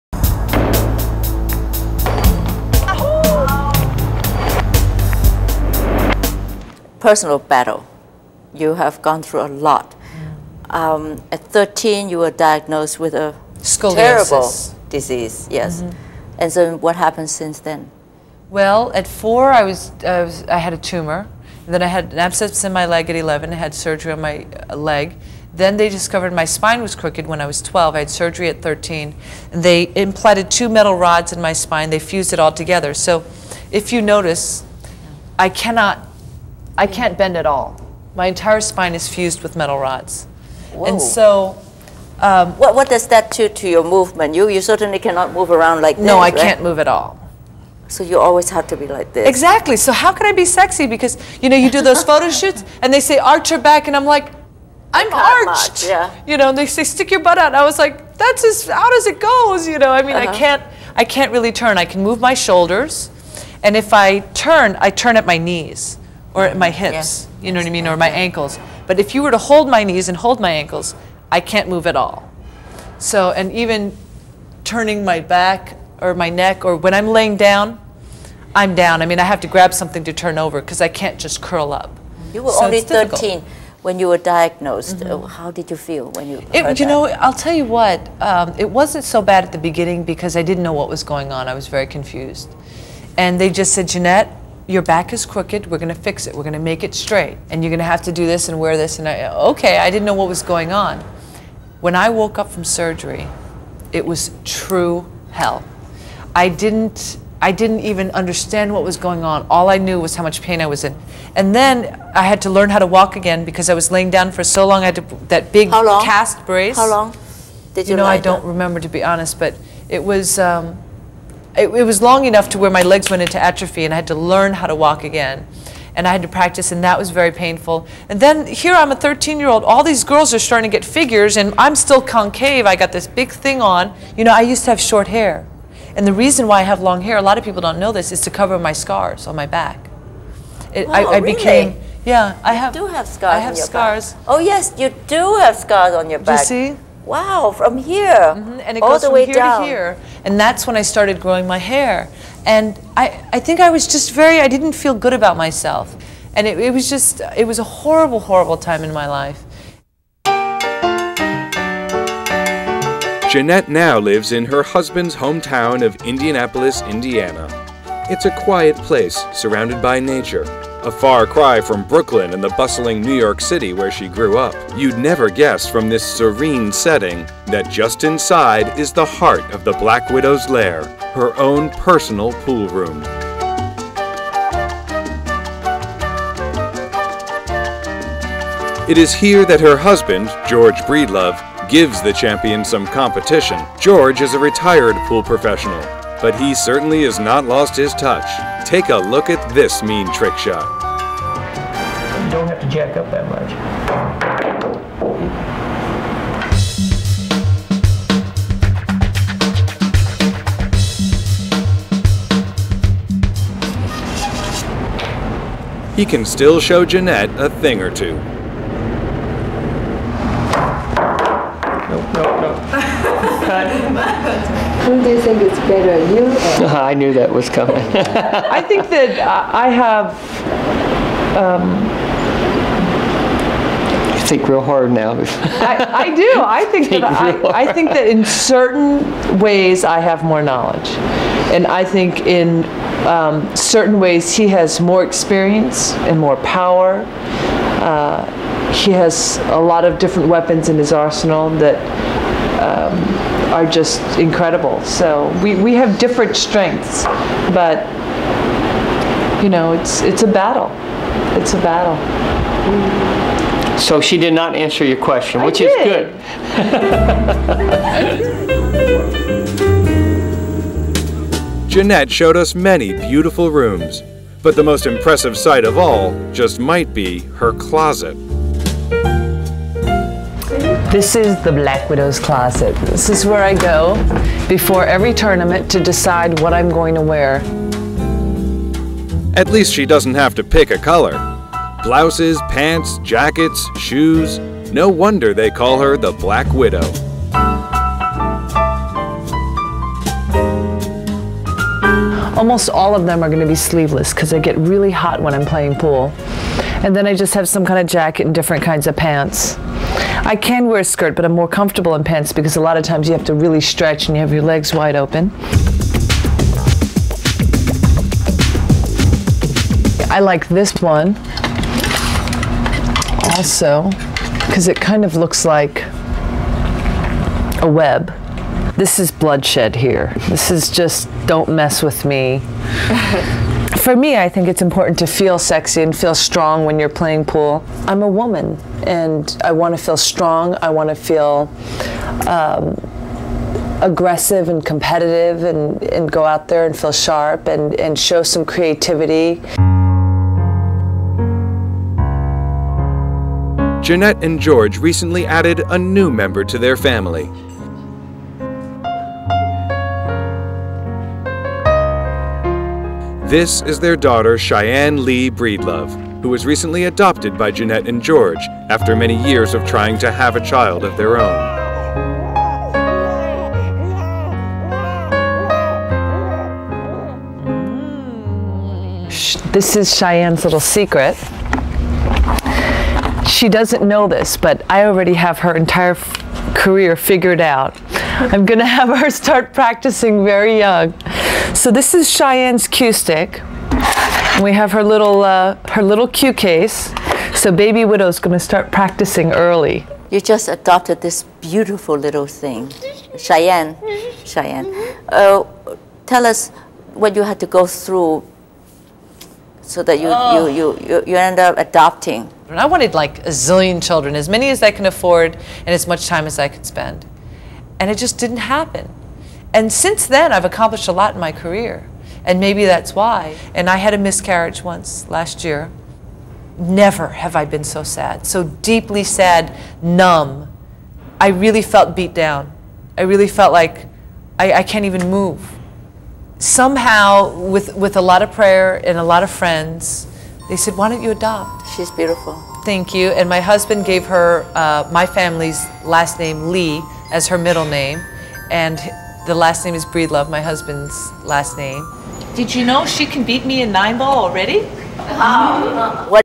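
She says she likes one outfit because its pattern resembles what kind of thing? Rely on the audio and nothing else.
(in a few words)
A web.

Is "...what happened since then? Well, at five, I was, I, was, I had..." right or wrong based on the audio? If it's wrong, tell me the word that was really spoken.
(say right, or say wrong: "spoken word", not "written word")
wrong: "four", not "five".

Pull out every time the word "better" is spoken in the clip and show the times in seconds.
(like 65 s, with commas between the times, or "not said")
225 s.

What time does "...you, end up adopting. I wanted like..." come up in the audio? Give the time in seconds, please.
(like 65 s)
411 s.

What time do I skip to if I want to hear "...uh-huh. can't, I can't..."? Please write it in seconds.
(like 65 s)
60 s.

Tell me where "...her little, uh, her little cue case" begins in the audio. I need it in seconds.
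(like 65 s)
394 s.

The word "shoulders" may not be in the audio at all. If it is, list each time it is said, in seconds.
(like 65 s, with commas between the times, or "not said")
62 s.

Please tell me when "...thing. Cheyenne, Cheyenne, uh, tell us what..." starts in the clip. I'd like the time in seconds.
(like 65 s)
402 s.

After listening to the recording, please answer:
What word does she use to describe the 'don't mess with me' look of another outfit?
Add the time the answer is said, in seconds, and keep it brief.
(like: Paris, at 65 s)
Bloodshed, at 329 s.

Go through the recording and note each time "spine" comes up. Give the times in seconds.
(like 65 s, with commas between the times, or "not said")
26 s, 31 s, 38 s.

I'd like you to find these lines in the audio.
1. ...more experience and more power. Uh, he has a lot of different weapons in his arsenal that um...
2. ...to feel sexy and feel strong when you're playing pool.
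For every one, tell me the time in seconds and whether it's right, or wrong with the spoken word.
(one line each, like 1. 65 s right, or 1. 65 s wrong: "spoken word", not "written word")
1. 244 s right
2. 334 s right.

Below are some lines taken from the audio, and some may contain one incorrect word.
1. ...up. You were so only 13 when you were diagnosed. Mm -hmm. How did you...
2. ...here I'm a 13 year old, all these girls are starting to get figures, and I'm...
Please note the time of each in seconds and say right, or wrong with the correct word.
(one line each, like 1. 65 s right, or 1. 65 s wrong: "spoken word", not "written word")
1. 81 s right
2. 128 s right.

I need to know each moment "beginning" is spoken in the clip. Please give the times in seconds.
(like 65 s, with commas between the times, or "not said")
89 s.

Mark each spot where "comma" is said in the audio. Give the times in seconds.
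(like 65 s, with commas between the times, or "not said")
not said.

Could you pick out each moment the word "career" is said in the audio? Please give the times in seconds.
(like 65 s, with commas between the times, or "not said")
386 s, 421 s.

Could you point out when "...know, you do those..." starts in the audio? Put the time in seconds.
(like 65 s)
51 s.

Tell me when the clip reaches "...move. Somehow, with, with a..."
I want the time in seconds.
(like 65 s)
435 s.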